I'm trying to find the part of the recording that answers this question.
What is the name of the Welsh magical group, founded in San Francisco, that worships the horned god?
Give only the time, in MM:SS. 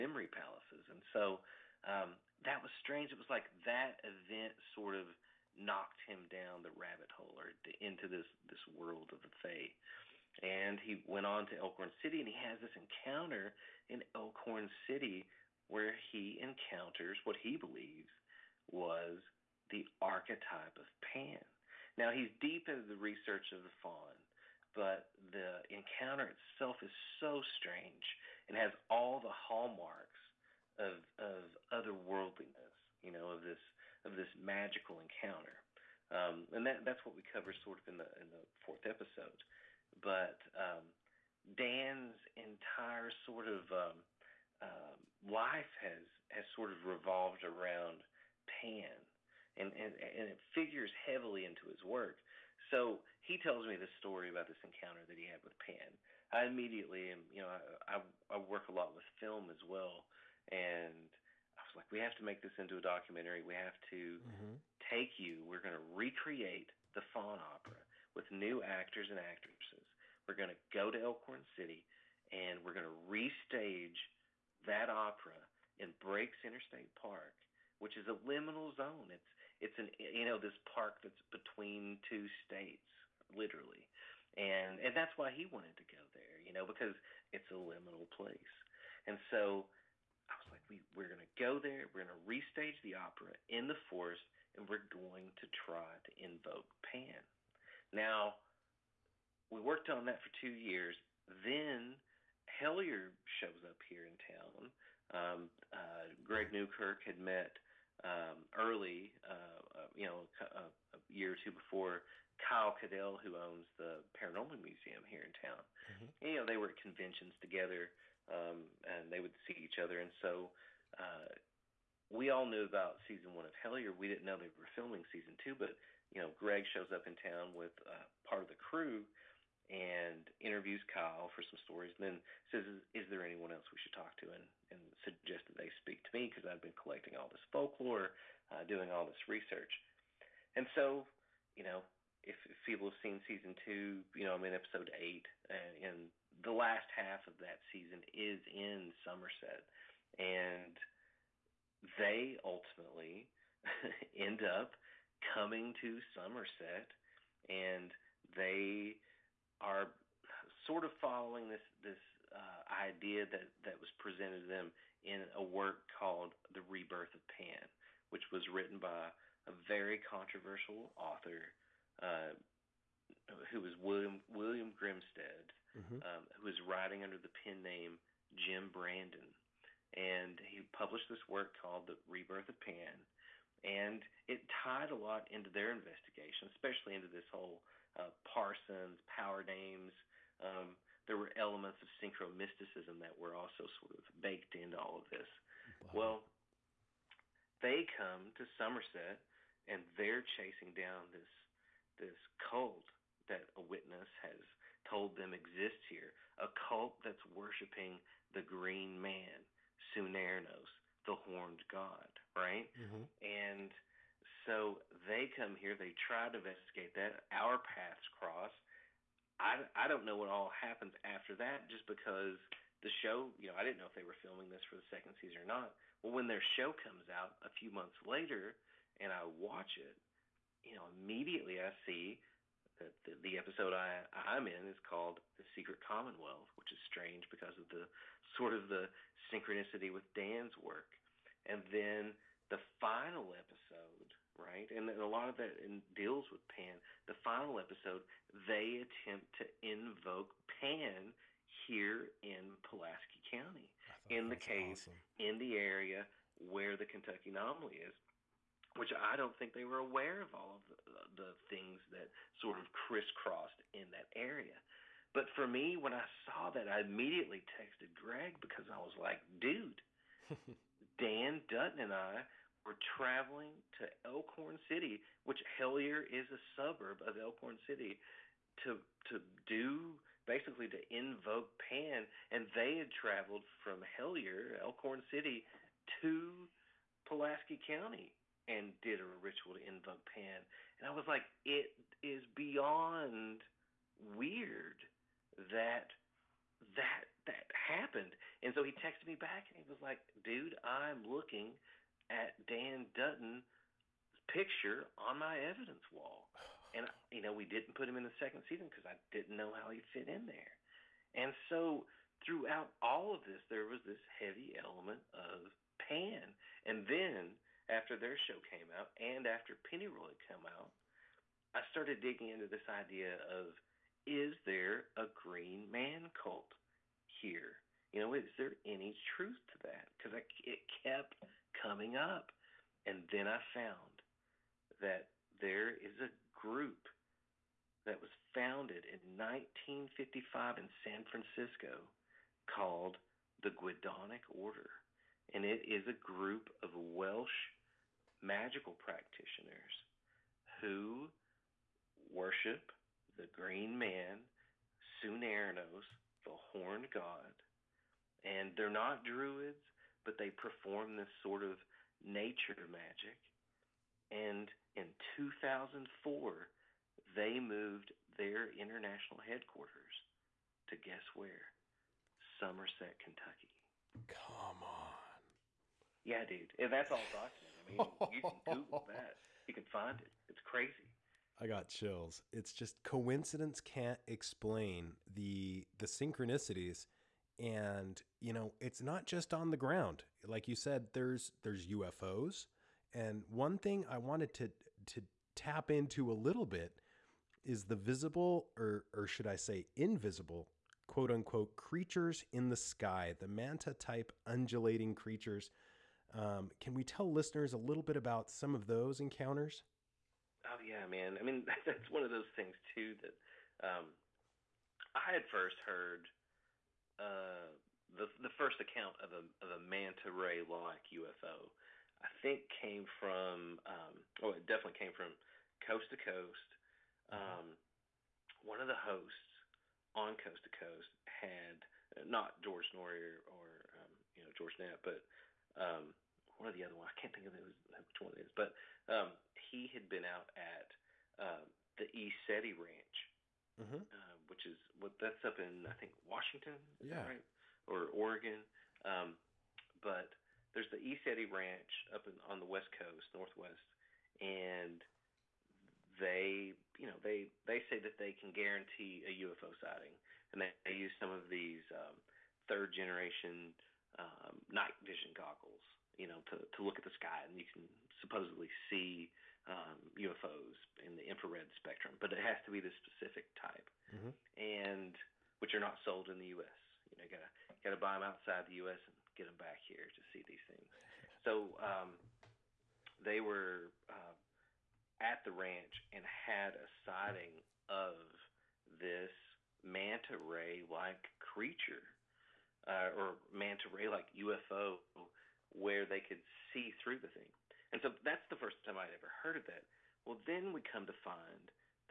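05:43.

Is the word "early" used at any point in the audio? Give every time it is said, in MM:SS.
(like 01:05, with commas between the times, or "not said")
01:48.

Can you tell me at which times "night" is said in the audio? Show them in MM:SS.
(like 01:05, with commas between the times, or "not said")
07:44.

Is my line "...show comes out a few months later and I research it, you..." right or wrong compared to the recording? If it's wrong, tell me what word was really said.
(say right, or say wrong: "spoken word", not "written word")
wrong: "watch", not "research".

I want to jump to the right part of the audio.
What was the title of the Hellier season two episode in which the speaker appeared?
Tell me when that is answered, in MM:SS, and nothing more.
03:55.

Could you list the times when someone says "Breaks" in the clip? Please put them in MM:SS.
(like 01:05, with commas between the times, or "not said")
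01:15.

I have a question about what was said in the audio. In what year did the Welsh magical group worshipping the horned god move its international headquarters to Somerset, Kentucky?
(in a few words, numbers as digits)
2004.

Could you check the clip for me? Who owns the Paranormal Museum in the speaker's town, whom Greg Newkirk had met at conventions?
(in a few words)
Kyle Cadell.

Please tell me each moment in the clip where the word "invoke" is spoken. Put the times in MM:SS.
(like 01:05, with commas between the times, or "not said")
01:36, 04:09, 04:40, 04:49.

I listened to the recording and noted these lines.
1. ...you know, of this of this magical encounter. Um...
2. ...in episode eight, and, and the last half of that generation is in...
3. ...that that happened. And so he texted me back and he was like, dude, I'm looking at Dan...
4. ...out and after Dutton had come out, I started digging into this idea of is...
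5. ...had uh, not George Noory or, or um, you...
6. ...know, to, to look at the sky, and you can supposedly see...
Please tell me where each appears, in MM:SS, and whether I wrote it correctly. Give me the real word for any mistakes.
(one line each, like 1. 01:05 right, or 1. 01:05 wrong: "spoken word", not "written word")
1. 00:32 right
2. 02:24 wrong: "season", not "generation"
3. 04:56 right
4. 05:18 wrong: "Pennyroyal", not "Dutton"
5. 07:11 right
6. 07:46 right.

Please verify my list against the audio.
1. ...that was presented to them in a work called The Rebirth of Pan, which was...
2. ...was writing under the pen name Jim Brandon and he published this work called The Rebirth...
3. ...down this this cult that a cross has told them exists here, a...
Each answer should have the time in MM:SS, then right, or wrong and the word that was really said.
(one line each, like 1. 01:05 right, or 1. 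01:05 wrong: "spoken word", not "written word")
1. 02:43 right
2. 02:56 right
3. 03:20 wrong: "witness", not "cross".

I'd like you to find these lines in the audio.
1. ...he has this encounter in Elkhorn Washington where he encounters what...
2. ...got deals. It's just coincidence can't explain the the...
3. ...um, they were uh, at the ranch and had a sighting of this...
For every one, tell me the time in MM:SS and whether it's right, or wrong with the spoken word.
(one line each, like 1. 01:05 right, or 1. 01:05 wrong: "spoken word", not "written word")
1. 00:12 wrong: "City", not "Washington"
2. 06:21 wrong: "chills", not "deals"
3. 08:01 right.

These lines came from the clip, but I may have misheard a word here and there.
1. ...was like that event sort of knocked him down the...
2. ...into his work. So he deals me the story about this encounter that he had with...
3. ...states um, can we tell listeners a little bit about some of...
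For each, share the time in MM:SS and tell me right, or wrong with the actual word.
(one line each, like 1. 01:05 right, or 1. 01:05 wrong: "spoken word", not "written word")
1. 00:03 right
2. 00:51 wrong: "tells", not "deals"
3. 06:44 wrong: "creatures", not "states".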